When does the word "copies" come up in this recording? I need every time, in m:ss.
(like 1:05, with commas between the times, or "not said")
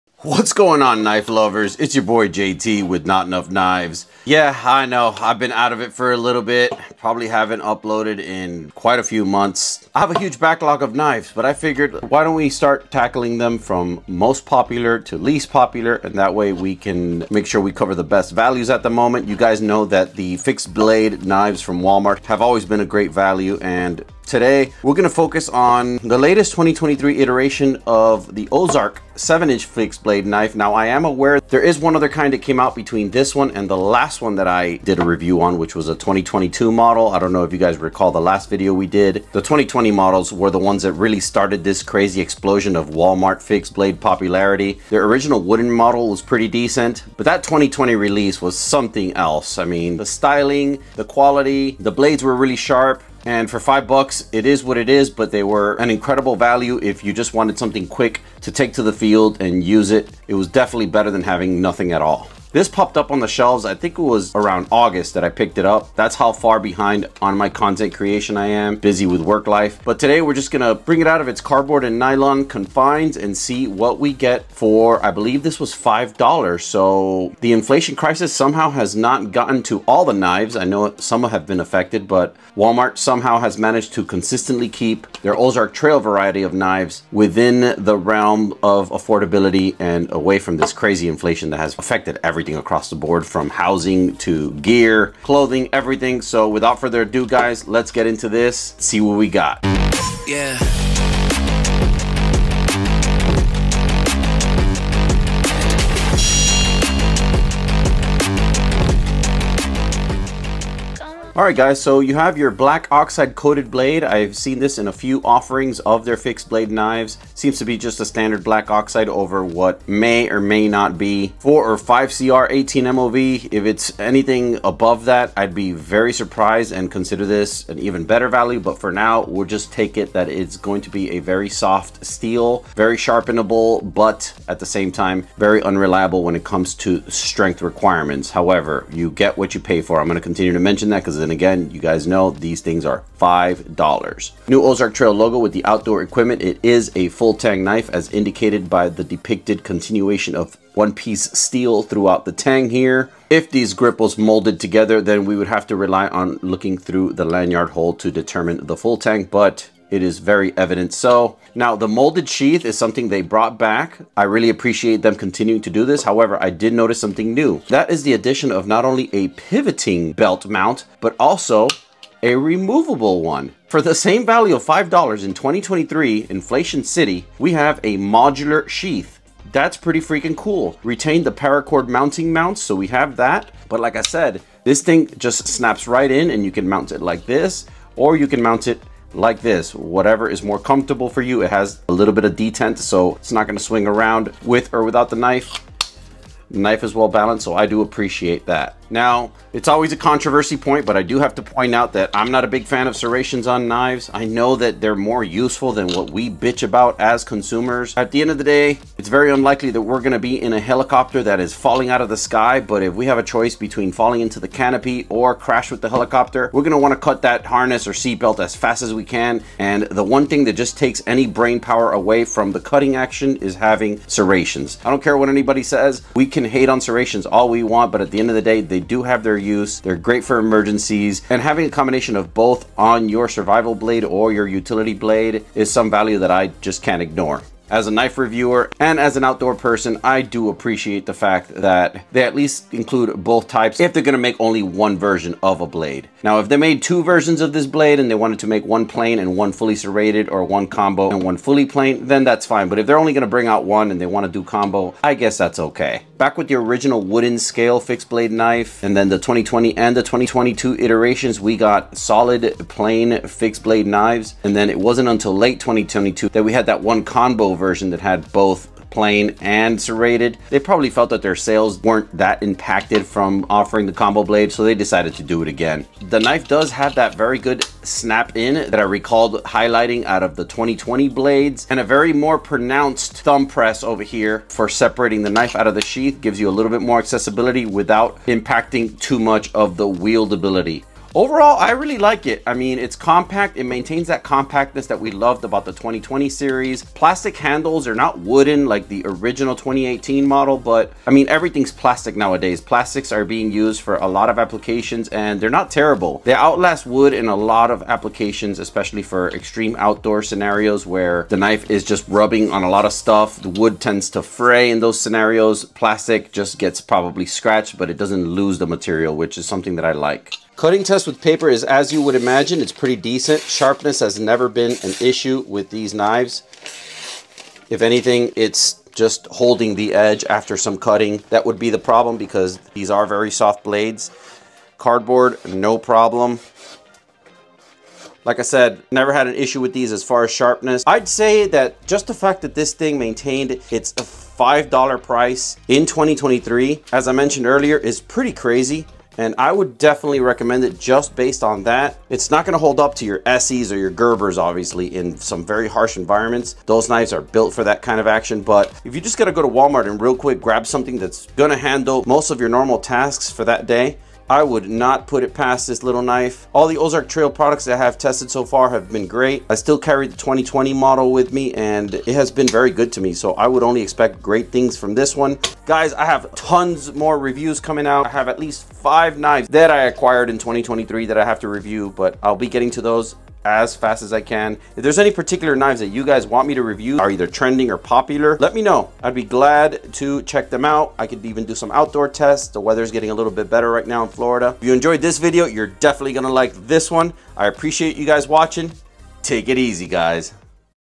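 not said.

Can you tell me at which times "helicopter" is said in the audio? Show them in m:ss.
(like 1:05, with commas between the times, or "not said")
3:30, 3:35.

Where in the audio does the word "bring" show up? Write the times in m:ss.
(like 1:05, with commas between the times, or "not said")
1:10, 4:13.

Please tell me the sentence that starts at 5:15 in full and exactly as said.
Plastic just gets probably scratched, but it doesn't lose the material, which is something that I like.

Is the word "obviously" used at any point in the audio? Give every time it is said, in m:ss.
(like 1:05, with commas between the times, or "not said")
5:54.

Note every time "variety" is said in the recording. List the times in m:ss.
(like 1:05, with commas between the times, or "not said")
1:26.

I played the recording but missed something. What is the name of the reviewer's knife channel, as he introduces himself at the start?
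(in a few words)
Not Nuff Knives.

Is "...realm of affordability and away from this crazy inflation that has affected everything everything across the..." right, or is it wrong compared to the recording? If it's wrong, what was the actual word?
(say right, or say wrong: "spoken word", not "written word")
right.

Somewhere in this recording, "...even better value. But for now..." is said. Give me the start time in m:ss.
2:07.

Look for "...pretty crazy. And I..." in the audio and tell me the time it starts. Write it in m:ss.
5:48.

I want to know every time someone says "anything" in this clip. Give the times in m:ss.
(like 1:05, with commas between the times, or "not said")
2:03, 5:27.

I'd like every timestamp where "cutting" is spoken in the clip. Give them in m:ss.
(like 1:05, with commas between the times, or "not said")
3:42, 5:20, 5:30.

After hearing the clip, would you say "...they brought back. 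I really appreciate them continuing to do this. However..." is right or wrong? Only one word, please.
right.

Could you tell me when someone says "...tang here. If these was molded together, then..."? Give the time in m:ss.
2:32.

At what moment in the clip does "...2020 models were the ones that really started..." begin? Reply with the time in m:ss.
0:39.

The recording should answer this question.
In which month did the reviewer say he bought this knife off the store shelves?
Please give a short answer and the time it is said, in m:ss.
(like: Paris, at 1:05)
August, at 1:04.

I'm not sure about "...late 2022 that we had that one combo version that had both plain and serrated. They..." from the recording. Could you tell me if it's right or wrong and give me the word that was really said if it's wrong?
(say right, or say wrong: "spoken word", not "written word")
right.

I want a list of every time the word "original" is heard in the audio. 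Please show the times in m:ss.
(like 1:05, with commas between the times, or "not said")
0:45, 4:16, 4:59.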